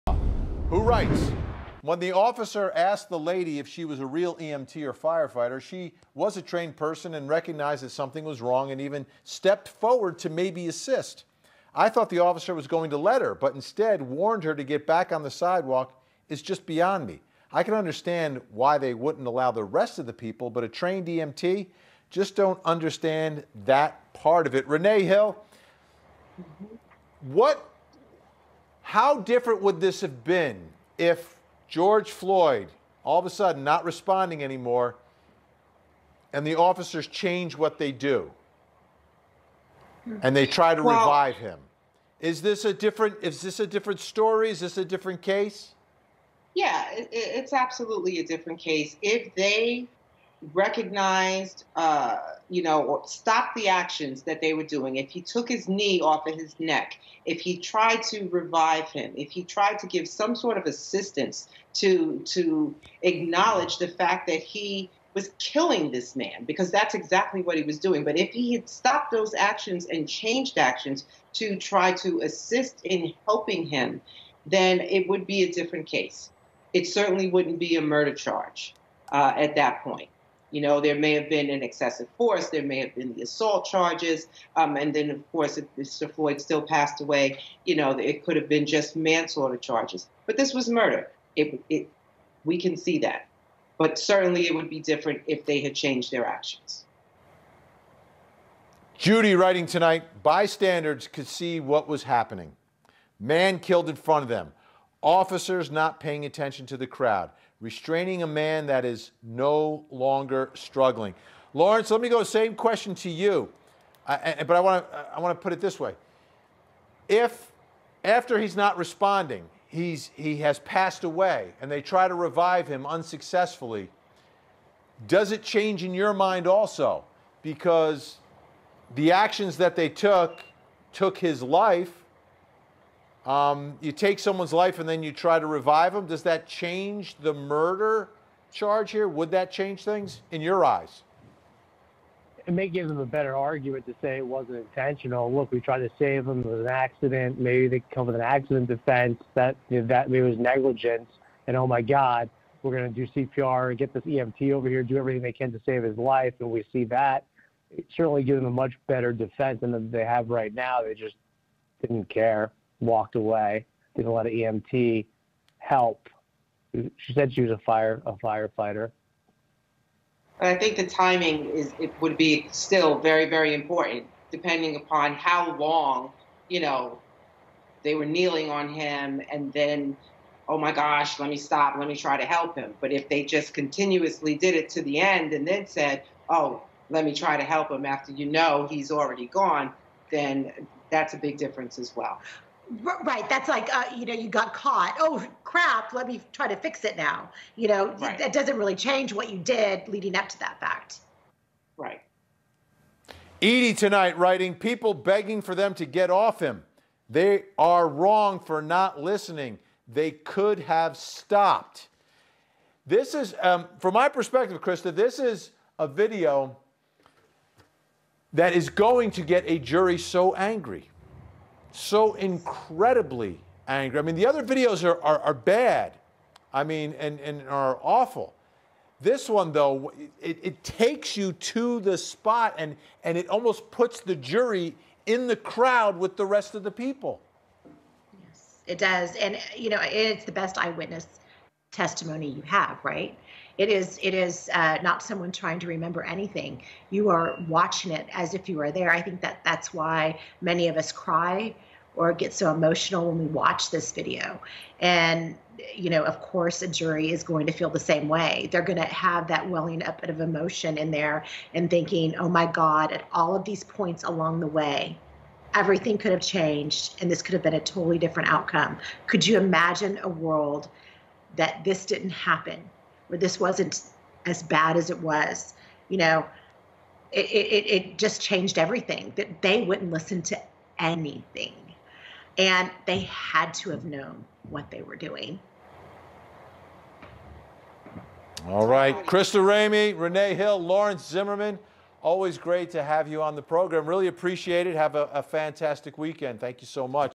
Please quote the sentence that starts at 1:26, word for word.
Floyd still passed away, you know, it could have been just manslaughter charges.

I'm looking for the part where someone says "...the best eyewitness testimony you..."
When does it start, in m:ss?
4:00.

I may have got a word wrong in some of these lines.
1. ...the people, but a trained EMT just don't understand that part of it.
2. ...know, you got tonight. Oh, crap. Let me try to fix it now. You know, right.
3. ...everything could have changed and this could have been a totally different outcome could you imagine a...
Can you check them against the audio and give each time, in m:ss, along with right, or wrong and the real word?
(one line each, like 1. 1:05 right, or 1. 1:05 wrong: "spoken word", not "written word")
1. 0:20 right
2. 3:14 wrong: "caught", not "tonight"
3. 4:25 right.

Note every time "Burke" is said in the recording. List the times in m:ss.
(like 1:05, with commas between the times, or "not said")
not said.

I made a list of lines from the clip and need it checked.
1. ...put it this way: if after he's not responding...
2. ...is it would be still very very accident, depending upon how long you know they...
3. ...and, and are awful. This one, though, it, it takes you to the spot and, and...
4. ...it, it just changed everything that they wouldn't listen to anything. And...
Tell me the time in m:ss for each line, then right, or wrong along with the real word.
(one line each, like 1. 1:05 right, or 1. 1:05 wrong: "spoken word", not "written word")
1. 1:55 right
2. 2:51 wrong: "important", not "accident"
3. 3:46 right
4. 4:37 right.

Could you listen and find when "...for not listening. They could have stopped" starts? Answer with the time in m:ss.
3:28.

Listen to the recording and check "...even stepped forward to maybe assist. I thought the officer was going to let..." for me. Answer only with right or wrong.
right.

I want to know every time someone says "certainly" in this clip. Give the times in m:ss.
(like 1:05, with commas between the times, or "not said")
1:16, 1:33, 2:37.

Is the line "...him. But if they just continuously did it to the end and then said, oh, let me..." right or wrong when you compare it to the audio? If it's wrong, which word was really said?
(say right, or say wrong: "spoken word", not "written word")
right.